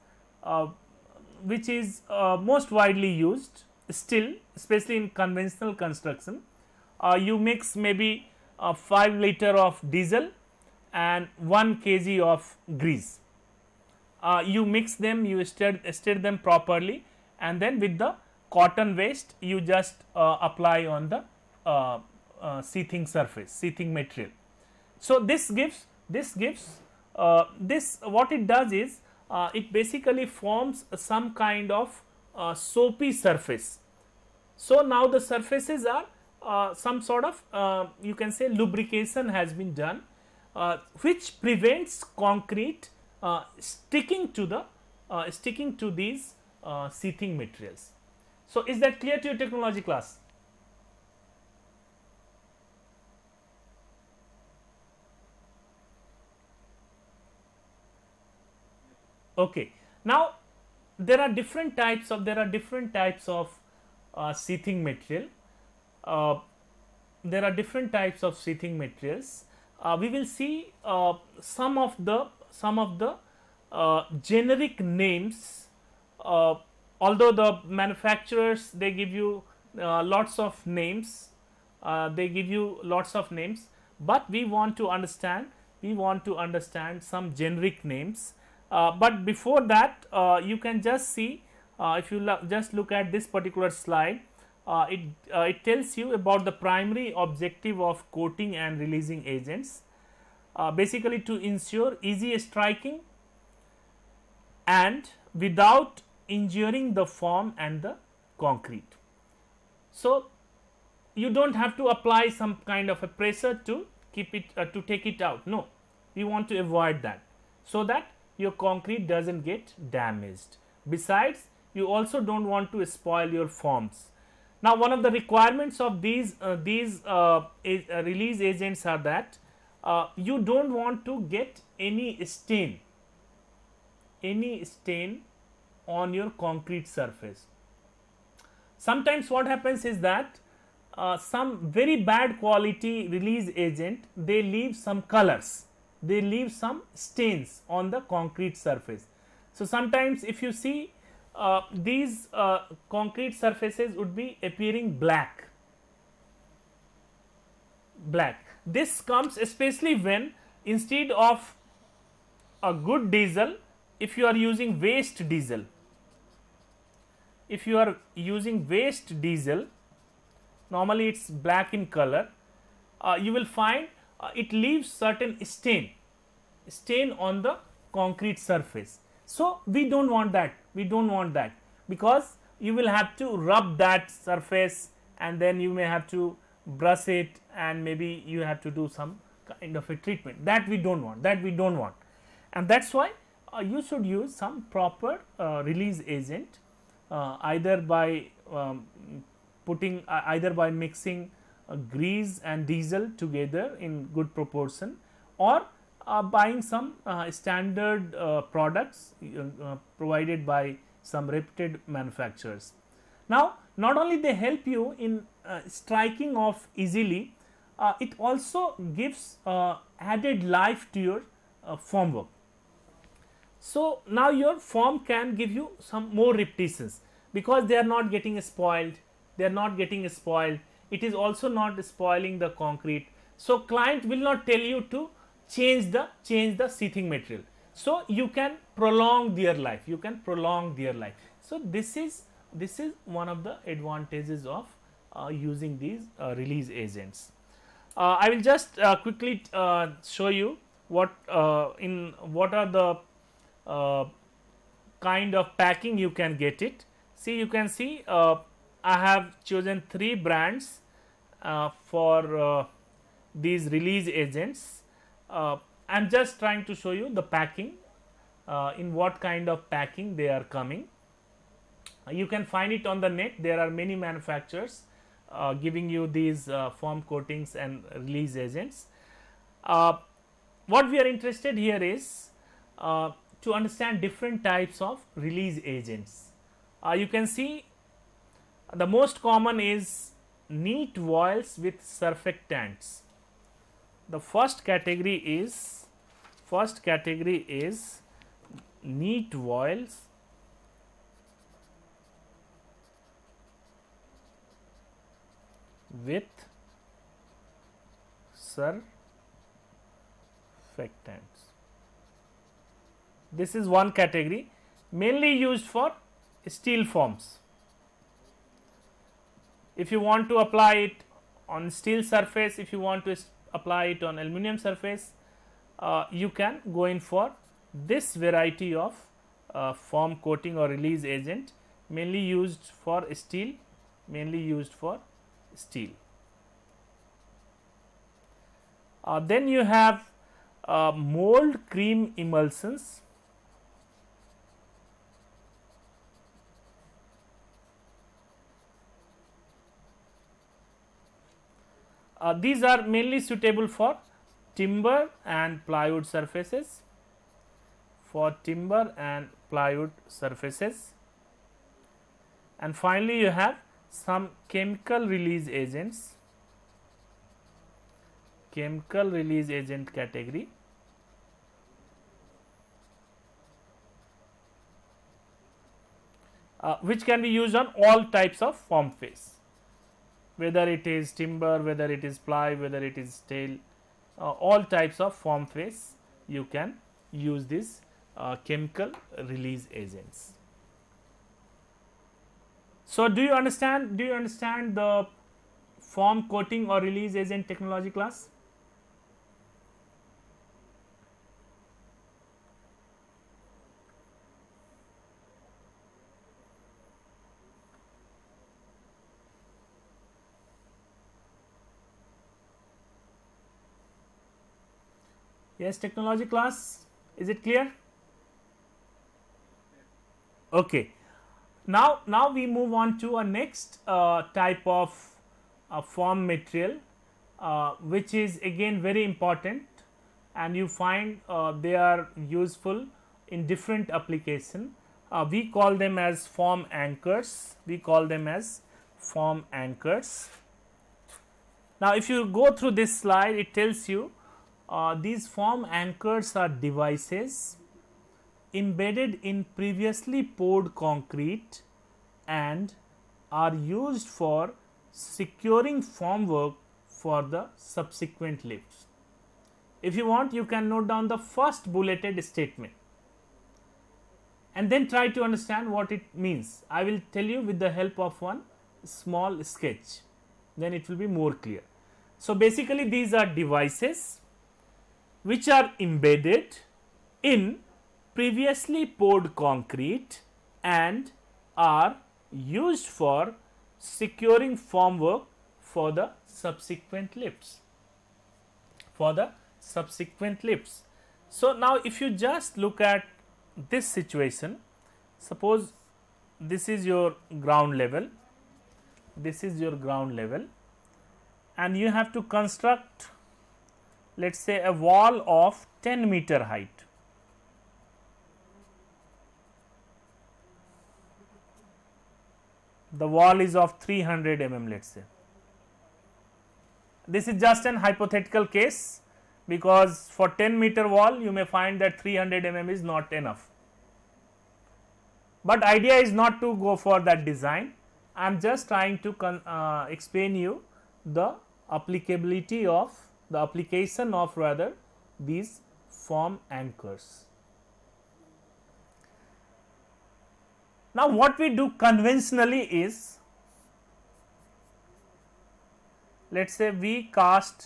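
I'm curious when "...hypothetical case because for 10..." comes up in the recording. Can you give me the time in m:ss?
8:37.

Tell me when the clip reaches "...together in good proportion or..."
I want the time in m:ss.
3:23.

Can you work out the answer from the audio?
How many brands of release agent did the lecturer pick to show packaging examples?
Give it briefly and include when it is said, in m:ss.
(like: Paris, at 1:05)
3, at 4:19.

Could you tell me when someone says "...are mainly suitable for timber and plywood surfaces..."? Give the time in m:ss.
5:52.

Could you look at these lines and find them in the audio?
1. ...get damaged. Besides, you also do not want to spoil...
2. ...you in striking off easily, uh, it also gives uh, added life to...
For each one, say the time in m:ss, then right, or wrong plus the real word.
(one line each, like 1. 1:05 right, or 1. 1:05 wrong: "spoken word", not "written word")
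1. 1:59 right
2. 3:34 right.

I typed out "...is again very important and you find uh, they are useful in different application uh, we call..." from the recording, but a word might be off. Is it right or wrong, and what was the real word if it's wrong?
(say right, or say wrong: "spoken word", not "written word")
right.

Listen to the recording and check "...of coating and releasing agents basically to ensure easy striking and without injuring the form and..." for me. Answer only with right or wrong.
right.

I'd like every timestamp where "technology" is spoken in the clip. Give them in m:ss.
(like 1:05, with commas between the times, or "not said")
0:49, 6:37, 6:55.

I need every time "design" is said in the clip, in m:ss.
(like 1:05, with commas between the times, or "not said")
8:47.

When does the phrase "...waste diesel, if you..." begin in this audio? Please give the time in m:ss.
2:44.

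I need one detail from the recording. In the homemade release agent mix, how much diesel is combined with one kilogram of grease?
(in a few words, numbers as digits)
5 liters.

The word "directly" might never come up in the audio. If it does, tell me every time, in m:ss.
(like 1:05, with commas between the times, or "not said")
not said.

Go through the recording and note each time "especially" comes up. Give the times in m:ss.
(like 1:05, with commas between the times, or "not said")
0:04, 2:39.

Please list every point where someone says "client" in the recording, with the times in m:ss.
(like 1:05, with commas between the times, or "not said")
3:53.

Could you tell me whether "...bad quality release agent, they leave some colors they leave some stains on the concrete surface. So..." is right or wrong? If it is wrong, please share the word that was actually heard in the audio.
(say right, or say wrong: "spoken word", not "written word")
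right.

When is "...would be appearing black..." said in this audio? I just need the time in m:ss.
2:33.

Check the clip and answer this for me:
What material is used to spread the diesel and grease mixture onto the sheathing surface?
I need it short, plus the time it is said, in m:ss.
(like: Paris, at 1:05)
cotton waste, at 0:18.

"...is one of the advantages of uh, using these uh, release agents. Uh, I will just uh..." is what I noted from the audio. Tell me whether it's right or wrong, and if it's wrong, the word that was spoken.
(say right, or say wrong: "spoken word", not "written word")
right.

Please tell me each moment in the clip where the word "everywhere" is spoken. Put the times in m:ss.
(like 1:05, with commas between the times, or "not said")
not said.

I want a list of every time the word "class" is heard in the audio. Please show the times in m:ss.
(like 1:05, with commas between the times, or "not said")
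0:49, 6:37, 6:56.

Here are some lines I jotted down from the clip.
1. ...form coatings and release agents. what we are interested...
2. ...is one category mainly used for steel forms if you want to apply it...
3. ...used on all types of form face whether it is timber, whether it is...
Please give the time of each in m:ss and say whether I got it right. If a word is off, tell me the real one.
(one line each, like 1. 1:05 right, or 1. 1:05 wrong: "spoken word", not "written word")
1. 4:36 right
2. 5:13 right
3. 6:17 right.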